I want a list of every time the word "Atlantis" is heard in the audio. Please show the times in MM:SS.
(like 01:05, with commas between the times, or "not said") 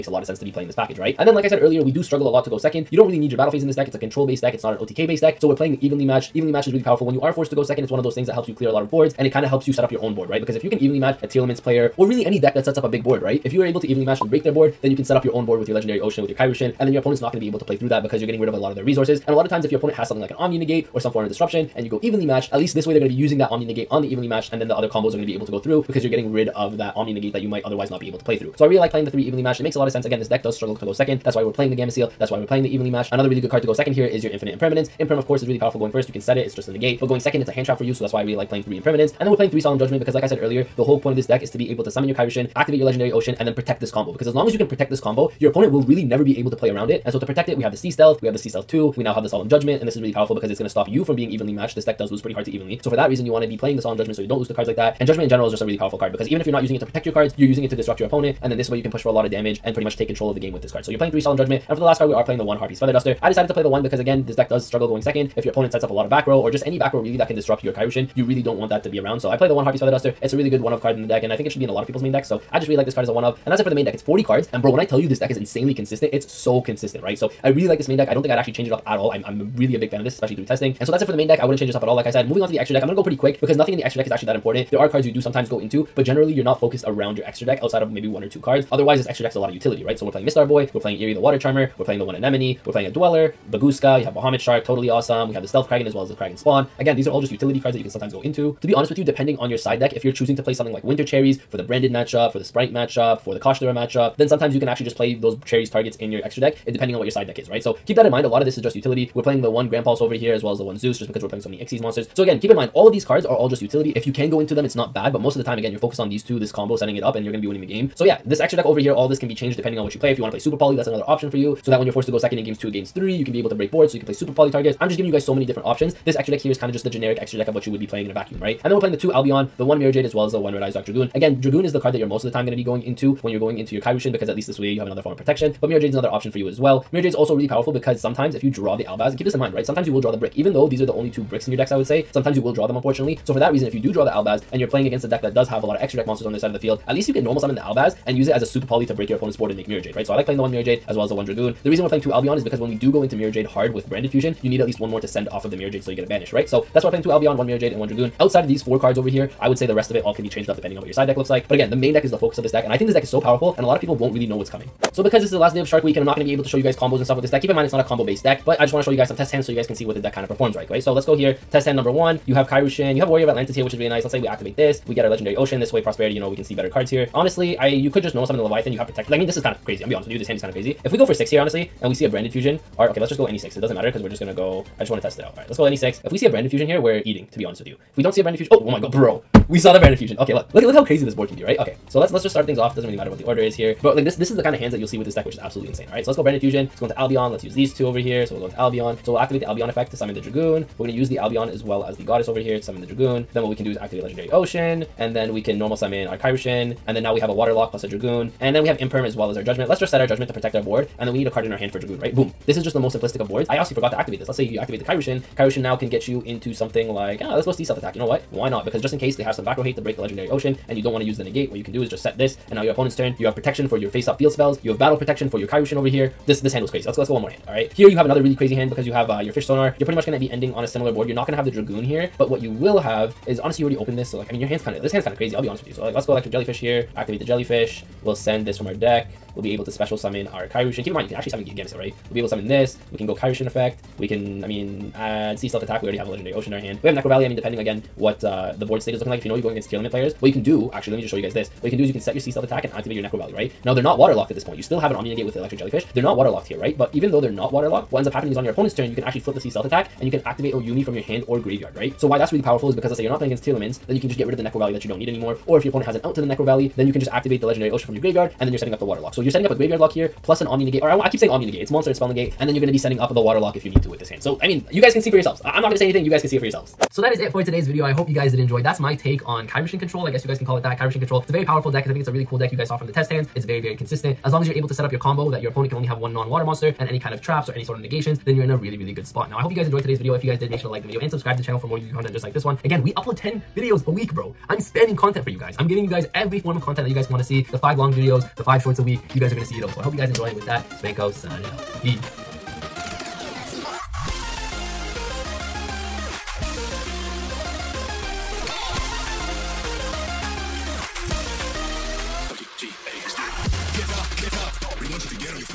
02:53.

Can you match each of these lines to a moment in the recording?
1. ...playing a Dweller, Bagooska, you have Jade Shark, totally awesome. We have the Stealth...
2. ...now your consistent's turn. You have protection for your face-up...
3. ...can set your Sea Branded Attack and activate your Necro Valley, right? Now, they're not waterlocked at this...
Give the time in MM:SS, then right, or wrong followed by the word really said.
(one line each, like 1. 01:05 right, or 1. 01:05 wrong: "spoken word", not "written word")
1. 01:32 wrong: "Bahamut", not "Jade"
2. 03:42 wrong: "opponent", not "consistent"
3. 04:11 wrong: "Stealth", not "Branded".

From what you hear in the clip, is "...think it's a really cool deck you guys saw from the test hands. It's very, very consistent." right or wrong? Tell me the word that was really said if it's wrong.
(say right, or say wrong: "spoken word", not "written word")
right.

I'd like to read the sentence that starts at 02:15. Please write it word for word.
But Mirror Jade's another option for you as well.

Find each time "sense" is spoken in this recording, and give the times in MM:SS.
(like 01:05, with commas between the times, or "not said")
00:00, 00:29.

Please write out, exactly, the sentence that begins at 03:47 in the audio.
Here you have another really crazy hand because you have uh, your fish sonar.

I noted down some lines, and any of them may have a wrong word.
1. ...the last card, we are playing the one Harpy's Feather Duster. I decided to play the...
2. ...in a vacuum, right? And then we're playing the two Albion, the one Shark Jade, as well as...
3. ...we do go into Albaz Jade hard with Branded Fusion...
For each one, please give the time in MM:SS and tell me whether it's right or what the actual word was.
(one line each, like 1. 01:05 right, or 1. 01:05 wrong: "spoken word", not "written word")
1. 01:01 right
2. 02:08 wrong: "Mirror", not "Shark"
3. 02:32 wrong: "Mirror", not "Albaz".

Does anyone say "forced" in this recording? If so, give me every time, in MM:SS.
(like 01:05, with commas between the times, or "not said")
00:07, 02:01.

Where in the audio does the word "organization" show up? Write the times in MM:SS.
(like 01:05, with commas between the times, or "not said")
not said.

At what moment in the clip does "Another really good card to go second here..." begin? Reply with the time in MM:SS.
00:33.